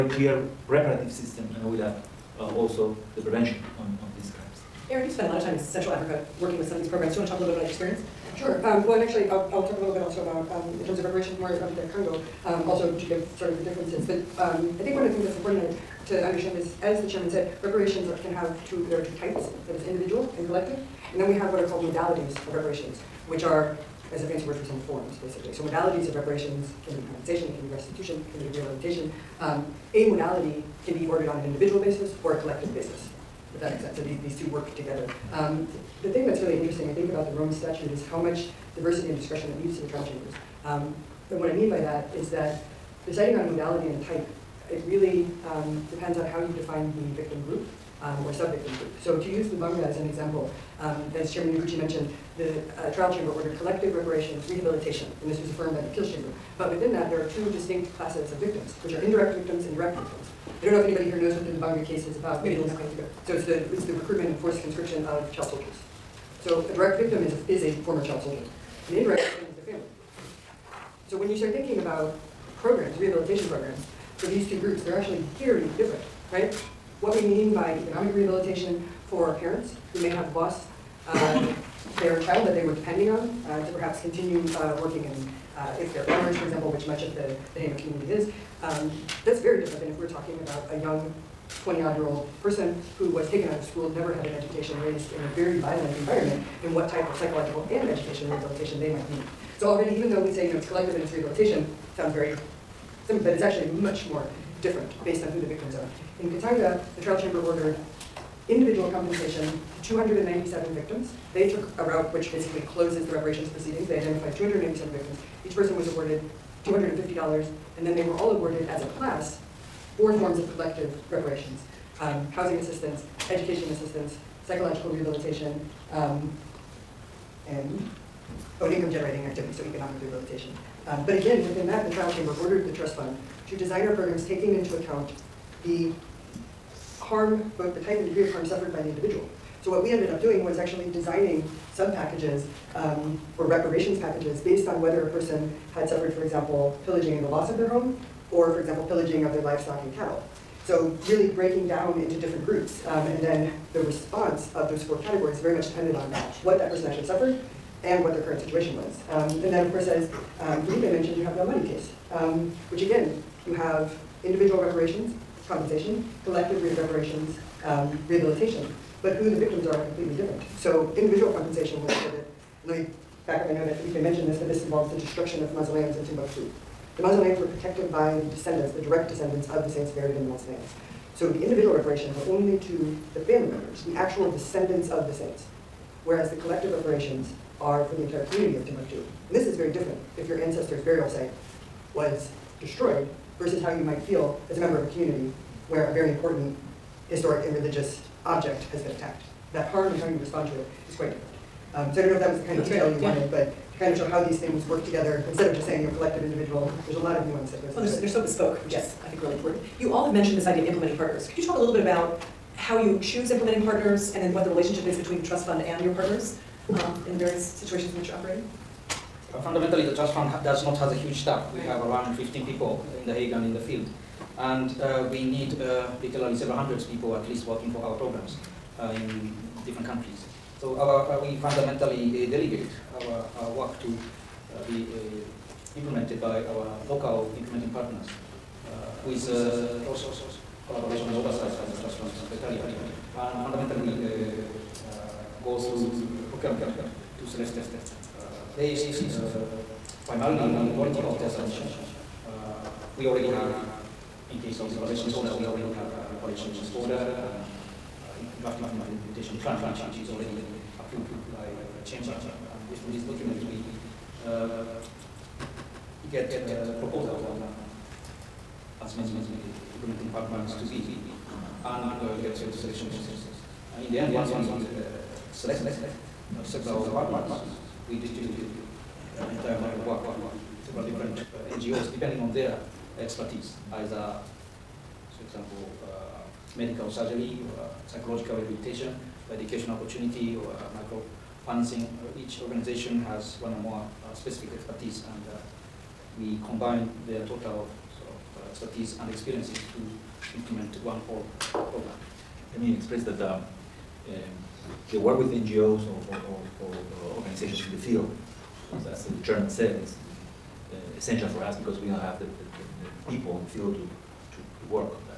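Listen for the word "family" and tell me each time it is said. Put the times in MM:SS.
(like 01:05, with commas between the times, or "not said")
01:09, 03:03.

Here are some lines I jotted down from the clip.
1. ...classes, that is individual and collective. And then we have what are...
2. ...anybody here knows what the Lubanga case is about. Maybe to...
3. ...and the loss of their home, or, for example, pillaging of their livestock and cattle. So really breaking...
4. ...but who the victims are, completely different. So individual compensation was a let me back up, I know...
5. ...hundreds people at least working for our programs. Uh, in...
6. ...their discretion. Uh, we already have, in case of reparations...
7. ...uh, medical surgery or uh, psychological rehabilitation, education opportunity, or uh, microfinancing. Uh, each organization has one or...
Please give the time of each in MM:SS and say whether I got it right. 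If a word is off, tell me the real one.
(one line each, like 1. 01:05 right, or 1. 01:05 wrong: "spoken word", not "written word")
1. 00:19 wrong: "types", not "classes"
2. 01:00 right
3. 02:27 right
4. 02:49 right
5. 03:46 right
6. 04:11 wrong: "submission", not "discretion"
7. 04:45 right.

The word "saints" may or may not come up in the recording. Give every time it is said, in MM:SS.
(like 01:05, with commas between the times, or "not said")
02:59, 03:05.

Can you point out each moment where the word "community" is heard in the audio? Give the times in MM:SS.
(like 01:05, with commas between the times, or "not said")
01:27, 03:08, 03:14.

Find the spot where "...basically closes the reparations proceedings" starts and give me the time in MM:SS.
01:52.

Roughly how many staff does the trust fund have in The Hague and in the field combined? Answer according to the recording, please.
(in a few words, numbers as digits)
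around 15.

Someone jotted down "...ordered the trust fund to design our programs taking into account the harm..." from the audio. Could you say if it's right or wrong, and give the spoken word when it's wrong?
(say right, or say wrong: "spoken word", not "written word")
right.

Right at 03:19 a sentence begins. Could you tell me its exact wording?
That harm and how you respond to it is quite different.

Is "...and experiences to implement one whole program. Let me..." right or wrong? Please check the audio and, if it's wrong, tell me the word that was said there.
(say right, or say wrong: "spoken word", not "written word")
right.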